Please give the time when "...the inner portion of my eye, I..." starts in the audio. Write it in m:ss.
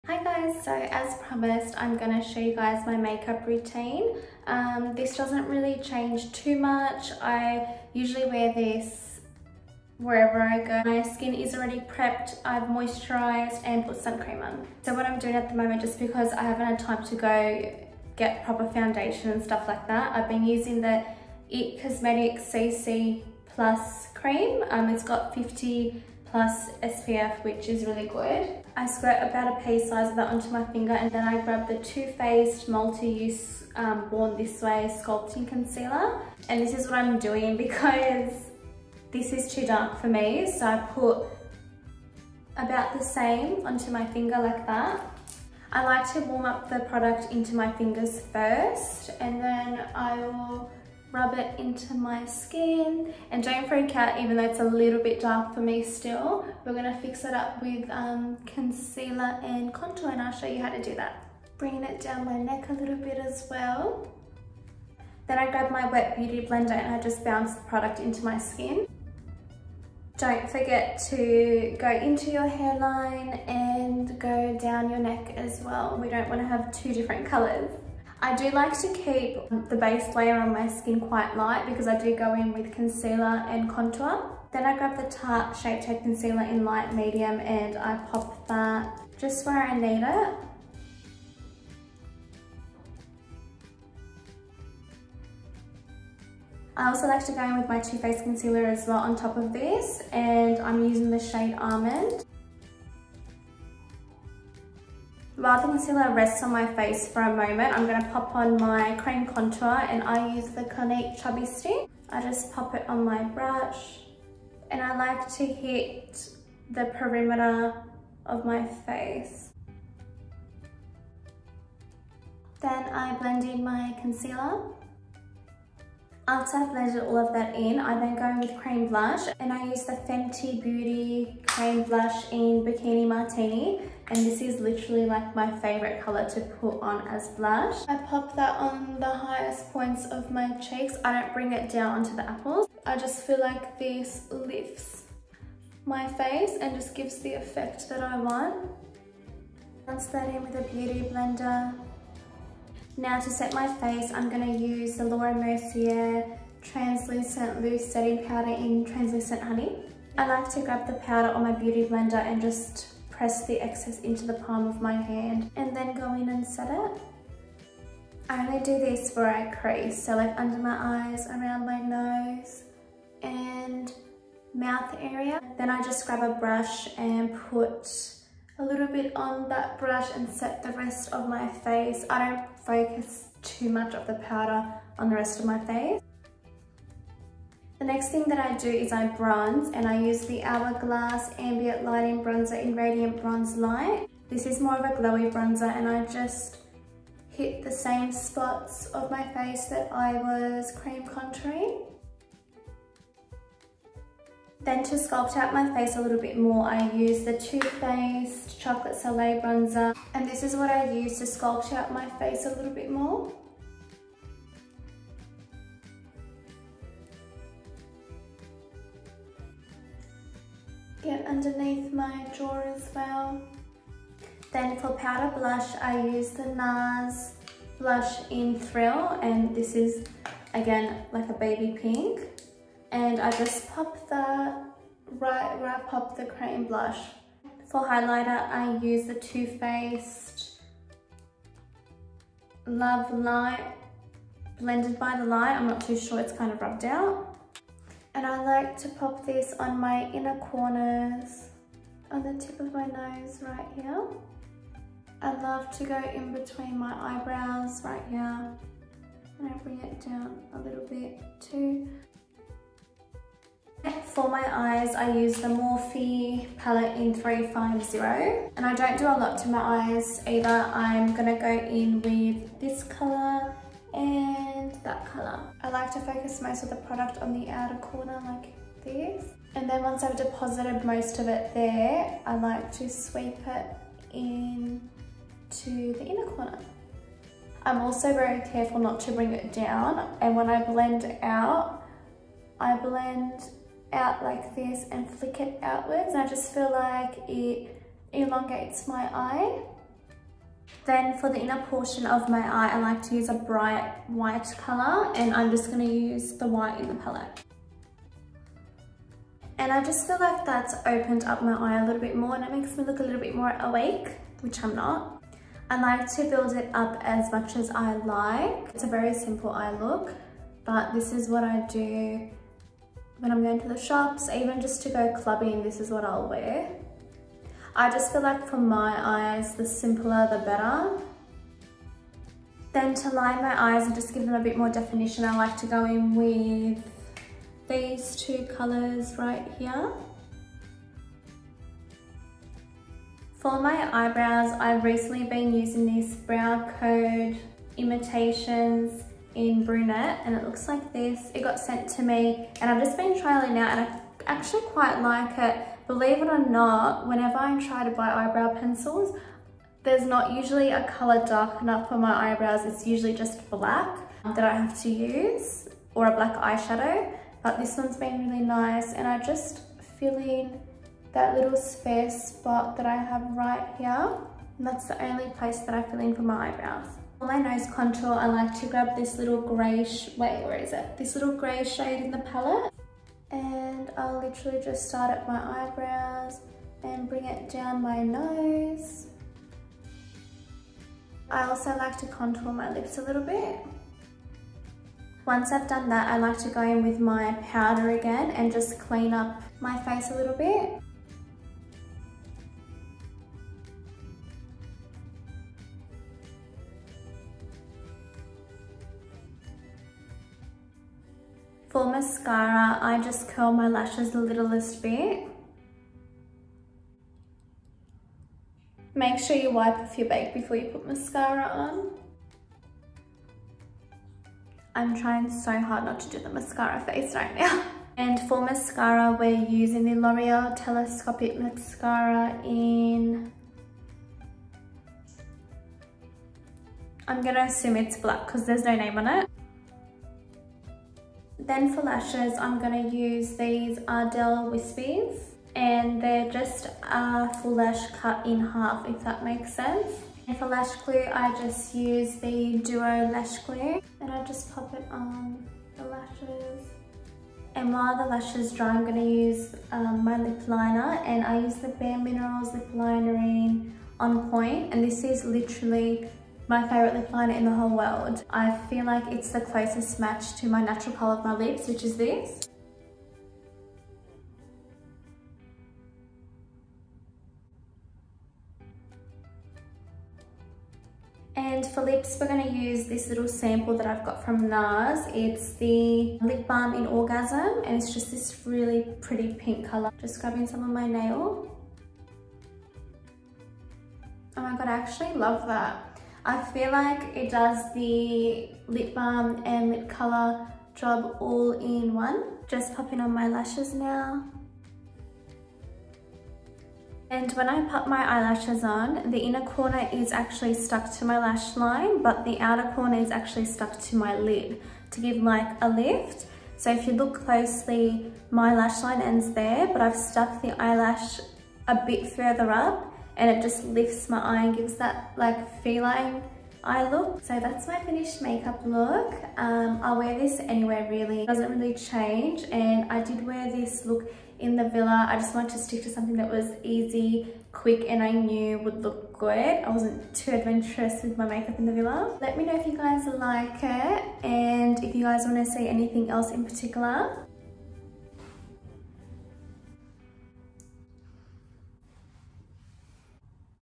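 5:01.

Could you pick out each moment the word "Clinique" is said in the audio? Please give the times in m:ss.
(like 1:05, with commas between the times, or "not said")
1:50.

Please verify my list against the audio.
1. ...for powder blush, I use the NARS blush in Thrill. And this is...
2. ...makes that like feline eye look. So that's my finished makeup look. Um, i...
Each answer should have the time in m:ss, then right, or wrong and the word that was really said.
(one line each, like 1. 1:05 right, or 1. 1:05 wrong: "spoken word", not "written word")
1. 3:44 right
2. 8:44 wrong: "gives", not "makes".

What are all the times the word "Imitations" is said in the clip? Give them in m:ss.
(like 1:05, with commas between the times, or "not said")
5:47.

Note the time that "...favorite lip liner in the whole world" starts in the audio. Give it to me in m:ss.
7:46.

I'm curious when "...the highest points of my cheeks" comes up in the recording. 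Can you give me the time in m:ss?
2:19.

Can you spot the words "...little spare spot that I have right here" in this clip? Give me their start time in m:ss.
6:11.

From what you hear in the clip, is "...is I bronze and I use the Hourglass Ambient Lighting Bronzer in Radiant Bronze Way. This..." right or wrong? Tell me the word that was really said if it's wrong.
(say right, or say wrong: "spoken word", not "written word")
wrong: "Light", not "Way".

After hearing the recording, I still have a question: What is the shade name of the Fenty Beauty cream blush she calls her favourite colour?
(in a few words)
Bikini Martini.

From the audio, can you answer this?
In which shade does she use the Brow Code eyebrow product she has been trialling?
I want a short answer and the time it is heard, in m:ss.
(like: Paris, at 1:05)
brunette, at 5:49.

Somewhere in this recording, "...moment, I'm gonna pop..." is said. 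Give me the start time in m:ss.
1:47.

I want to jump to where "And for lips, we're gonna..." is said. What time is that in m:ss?
8:01.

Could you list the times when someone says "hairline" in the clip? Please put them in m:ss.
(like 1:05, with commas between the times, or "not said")
1:12.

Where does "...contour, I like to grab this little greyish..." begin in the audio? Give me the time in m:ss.
6:17.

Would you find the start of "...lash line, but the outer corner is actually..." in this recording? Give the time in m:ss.
8:31.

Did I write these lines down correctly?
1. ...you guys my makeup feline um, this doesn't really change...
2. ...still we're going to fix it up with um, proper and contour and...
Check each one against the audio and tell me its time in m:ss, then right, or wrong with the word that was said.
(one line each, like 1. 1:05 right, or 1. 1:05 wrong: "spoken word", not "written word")
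1. 0:02 wrong: "routine", not "feline"
2. 0:55 wrong: "concealer", not "proper".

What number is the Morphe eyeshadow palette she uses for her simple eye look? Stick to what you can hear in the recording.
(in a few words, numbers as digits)
350.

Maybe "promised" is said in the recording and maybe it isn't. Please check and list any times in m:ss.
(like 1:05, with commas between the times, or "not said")
0:01.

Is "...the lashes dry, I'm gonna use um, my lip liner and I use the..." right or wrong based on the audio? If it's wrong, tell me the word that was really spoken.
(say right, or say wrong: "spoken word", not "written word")
right.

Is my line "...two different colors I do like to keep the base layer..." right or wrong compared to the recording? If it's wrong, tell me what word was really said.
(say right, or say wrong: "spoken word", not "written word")
right.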